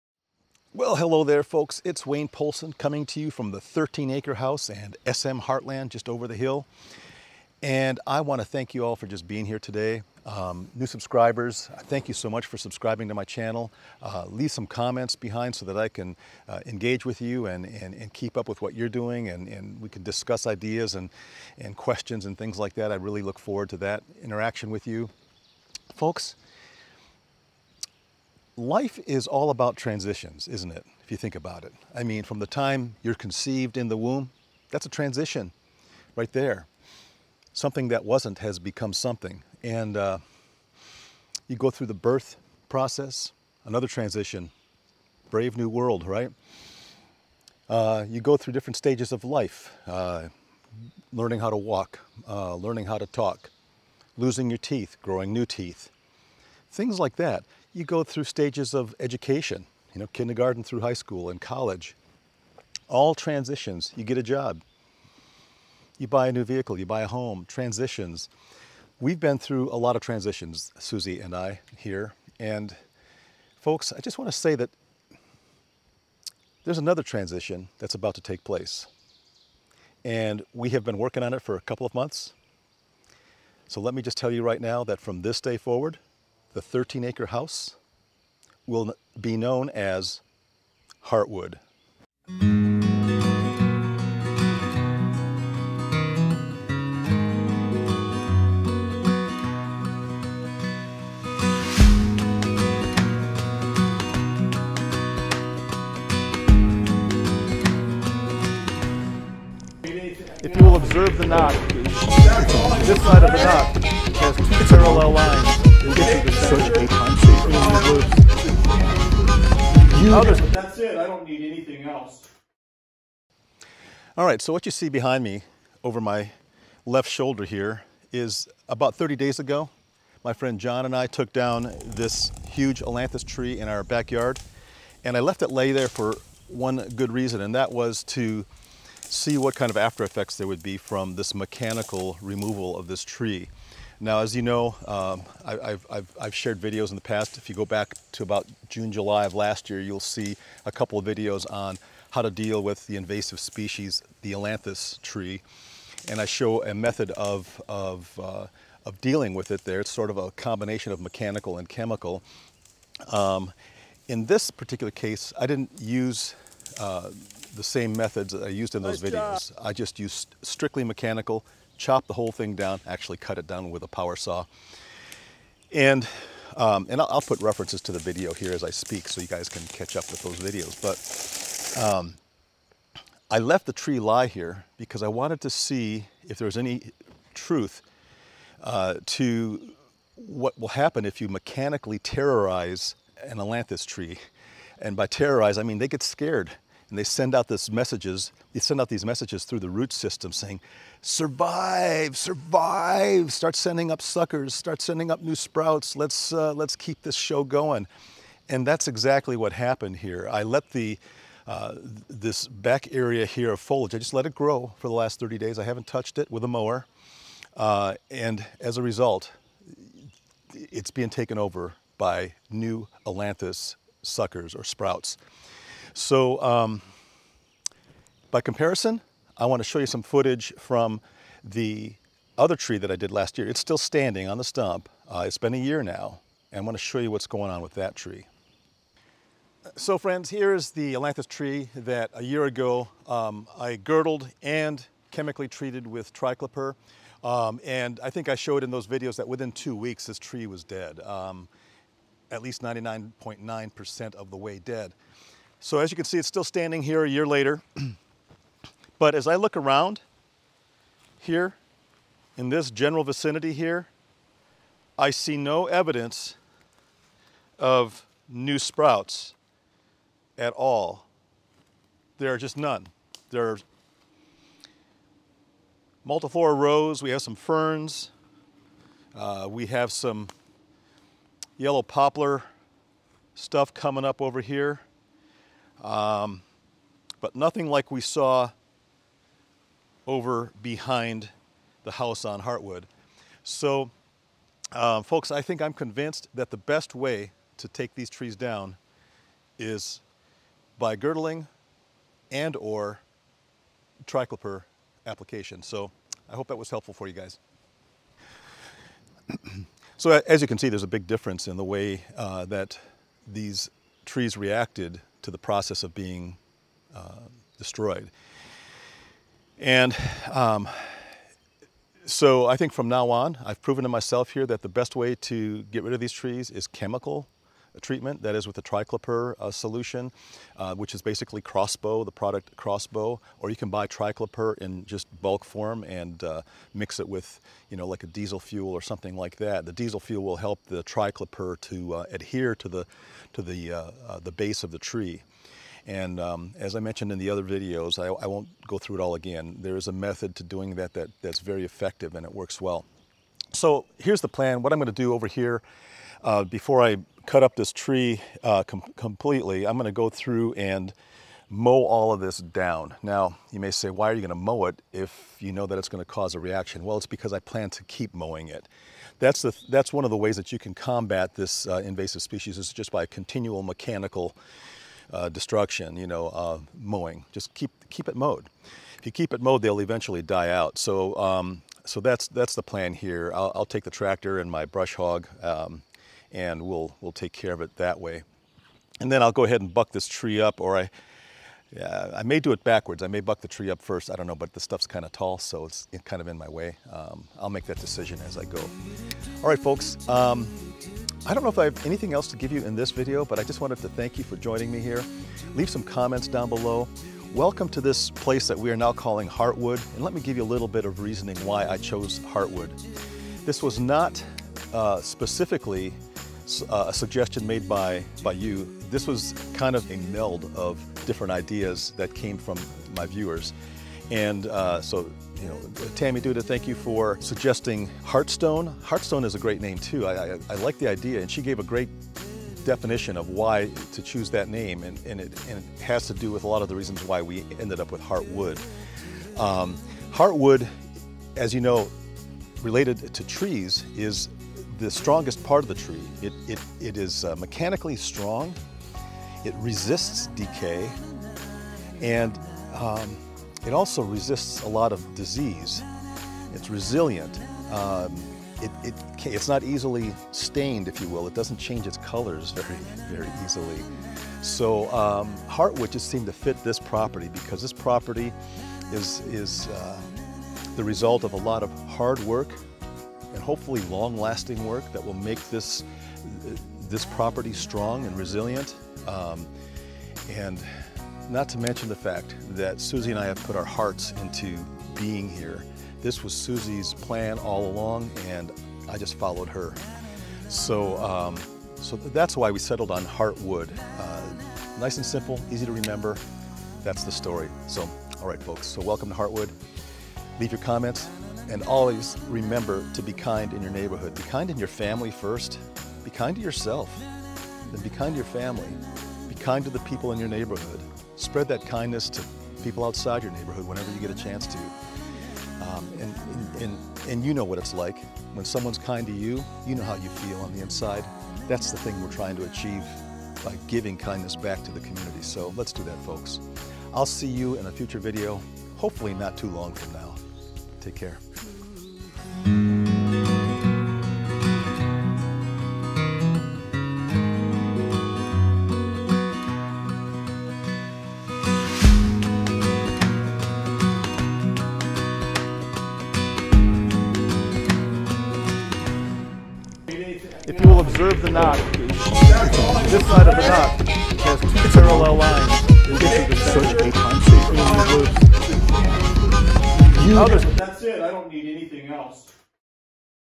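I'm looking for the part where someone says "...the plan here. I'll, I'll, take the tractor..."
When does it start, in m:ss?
6:22.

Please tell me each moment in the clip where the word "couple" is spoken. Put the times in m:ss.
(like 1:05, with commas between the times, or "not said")
1:21, 2:30.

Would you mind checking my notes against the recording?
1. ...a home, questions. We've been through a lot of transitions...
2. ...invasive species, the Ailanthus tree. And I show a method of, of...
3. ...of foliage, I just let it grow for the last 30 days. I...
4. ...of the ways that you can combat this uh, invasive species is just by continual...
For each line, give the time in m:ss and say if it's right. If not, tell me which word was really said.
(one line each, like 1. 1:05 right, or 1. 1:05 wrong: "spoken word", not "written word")
1. 1:07 wrong: "transitions", not "questions"
2. 2:32 right
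3. 3:33 right
4. 6:10 right.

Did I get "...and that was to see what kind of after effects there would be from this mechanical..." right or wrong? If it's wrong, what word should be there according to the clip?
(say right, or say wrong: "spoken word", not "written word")
right.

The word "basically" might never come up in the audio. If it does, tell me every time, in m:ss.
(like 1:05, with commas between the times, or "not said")
5:31.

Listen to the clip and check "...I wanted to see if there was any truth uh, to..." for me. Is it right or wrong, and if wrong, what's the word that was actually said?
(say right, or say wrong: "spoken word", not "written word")
right.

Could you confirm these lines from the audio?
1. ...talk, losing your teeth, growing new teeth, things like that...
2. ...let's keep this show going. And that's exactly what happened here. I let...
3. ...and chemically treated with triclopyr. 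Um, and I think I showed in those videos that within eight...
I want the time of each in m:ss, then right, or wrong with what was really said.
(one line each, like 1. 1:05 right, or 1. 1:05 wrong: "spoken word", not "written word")
1. 0:53 right
2. 3:26 right
3. 4:04 wrong: "two", not "eight".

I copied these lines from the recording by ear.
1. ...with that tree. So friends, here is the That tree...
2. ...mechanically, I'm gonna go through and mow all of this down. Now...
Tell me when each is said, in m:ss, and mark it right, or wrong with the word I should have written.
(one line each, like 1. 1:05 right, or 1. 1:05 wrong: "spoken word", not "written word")
1. 3:57 wrong: "Ailanthus", not "That"
2. 5:58 wrong: "completely", not "mechanically".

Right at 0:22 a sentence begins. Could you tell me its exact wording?
I really look forward to that interaction with you.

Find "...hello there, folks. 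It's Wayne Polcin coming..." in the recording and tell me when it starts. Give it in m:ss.
0:00.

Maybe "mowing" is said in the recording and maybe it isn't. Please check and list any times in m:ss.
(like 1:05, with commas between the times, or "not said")
6:08, 6:16.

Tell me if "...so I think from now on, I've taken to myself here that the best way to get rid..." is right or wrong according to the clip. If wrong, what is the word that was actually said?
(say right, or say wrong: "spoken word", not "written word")
wrong: "proven", not "taken".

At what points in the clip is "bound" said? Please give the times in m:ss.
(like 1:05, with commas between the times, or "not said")
not said.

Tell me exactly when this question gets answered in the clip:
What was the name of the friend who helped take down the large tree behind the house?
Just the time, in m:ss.
2:10.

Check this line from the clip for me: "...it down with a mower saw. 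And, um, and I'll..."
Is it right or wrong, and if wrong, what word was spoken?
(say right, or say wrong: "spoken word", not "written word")
wrong: "power", not "mower".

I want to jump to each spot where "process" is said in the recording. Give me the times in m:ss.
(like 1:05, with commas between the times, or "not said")
0:42, 5:15.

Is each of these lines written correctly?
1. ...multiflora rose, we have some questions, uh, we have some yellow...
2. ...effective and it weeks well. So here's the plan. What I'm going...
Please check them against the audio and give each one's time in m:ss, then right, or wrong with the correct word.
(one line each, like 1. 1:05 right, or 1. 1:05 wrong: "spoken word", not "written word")
1. 4:36 wrong: "ferns", not "questions"
2. 5:51 wrong: "works", not "weeks".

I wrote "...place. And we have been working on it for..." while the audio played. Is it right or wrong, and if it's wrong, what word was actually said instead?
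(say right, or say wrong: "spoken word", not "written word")
right.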